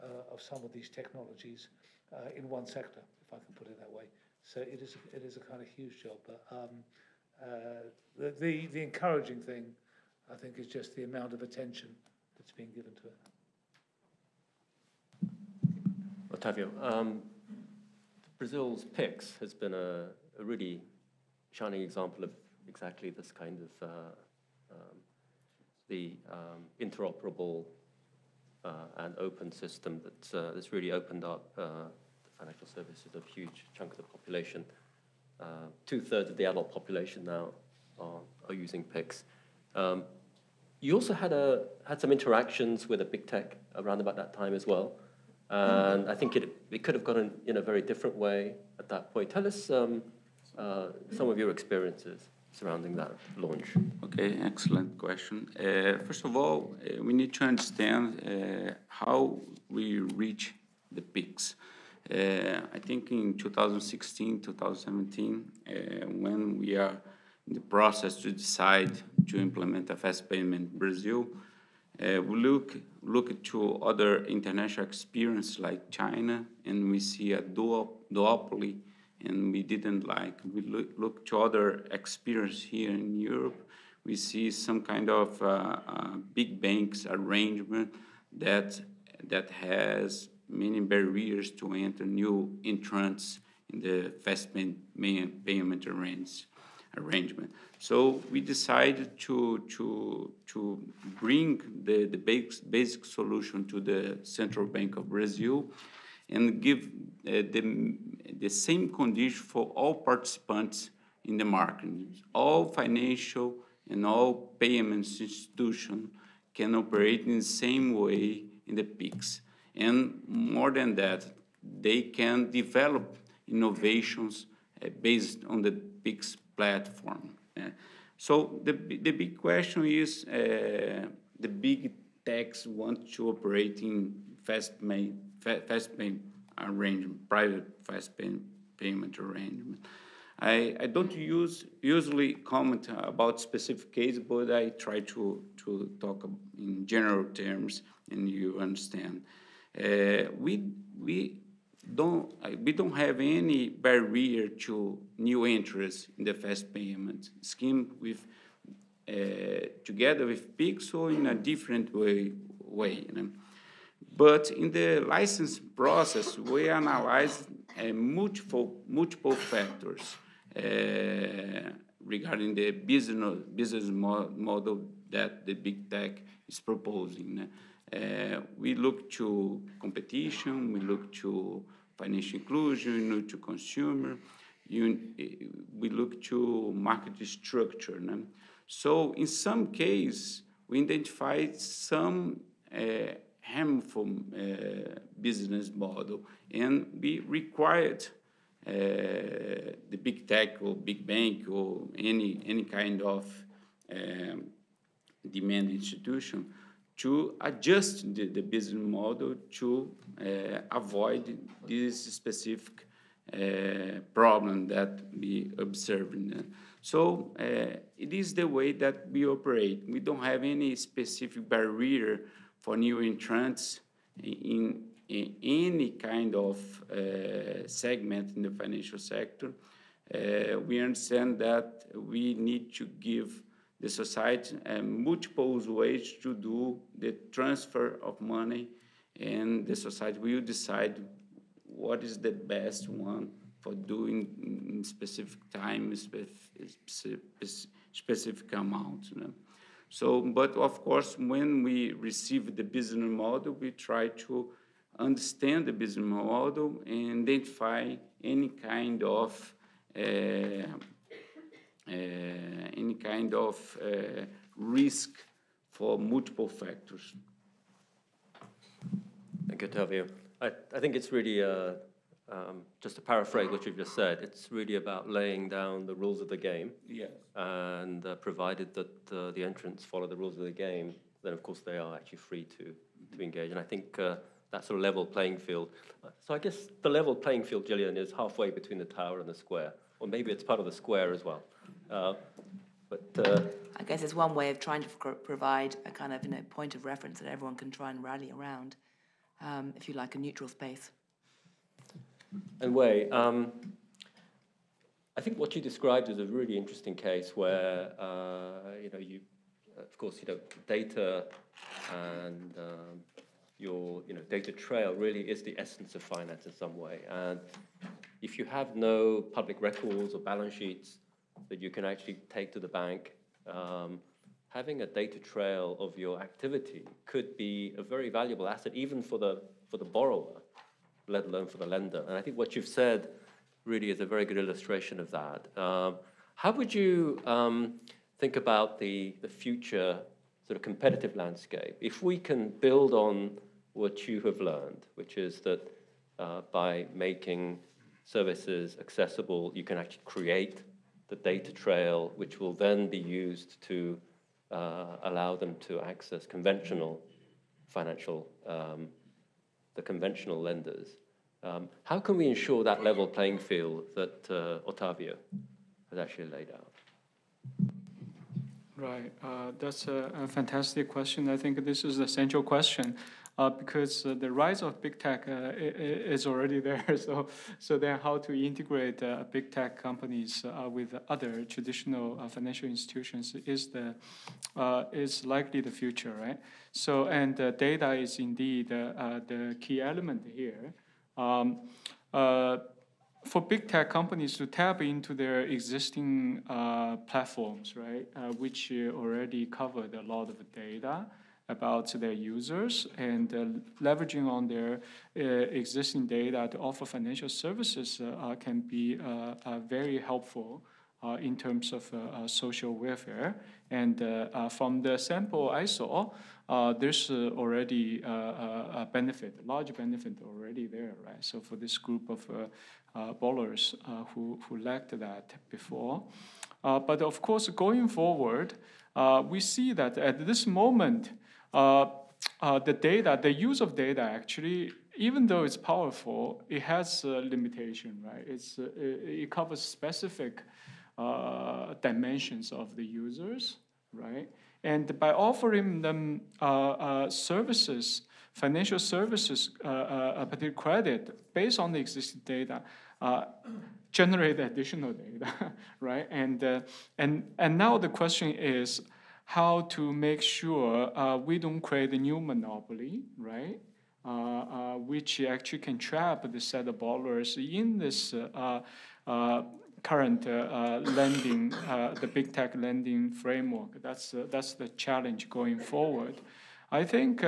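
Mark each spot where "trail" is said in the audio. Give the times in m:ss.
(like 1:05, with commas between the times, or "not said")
5:14, 5:25, 5:51.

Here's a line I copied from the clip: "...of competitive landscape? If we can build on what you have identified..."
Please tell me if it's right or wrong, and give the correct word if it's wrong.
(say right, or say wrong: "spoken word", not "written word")
wrong: "learned", not "identified".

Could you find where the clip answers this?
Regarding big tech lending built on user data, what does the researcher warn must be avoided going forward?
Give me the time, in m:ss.
7:41.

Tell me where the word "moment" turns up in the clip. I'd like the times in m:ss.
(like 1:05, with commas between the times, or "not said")
7:10.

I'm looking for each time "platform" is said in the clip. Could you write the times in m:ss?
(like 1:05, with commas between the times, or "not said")
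2:06, 6:37.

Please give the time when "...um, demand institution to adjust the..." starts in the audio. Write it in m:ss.
3:23.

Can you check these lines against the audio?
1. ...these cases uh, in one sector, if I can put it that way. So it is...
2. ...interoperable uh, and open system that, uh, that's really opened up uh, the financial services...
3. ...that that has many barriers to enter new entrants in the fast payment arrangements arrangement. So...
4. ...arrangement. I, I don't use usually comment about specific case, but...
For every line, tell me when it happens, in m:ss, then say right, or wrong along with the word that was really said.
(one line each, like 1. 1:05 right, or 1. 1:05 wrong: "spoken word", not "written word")
1. 0:00 wrong: "technologies", not "cases"
2. 0:26 right
3. 1:28 right
4. 2:19 right.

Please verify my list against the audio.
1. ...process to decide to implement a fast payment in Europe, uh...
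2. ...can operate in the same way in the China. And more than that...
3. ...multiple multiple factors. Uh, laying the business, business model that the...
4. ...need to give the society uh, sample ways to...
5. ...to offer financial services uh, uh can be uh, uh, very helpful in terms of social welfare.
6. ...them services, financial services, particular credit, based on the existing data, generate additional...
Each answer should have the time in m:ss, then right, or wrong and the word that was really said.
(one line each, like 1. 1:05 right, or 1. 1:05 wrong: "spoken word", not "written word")
1. 1:07 wrong: "Brazil", not "Europe"
2. 1:56 wrong: "PIX", not "China"
3. 2:47 wrong: "regarding", not "laying"
4. 3:52 wrong: "multiple", not "sample"
5. 6:46 right
6. 7:25 right.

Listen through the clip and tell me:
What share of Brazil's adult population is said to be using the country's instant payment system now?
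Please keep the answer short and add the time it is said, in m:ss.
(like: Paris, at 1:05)
two thirds, at 0:35.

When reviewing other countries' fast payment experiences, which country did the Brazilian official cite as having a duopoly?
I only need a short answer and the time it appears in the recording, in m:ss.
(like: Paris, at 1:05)
China, at 1:15.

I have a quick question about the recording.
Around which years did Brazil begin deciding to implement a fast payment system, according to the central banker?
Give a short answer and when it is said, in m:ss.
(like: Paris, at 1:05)
2016, 2017, at 1:03.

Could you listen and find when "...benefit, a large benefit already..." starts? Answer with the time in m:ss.
6:58.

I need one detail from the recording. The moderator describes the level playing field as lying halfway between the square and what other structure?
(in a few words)
the tower.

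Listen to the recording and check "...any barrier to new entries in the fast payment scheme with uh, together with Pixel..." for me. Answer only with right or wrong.
right.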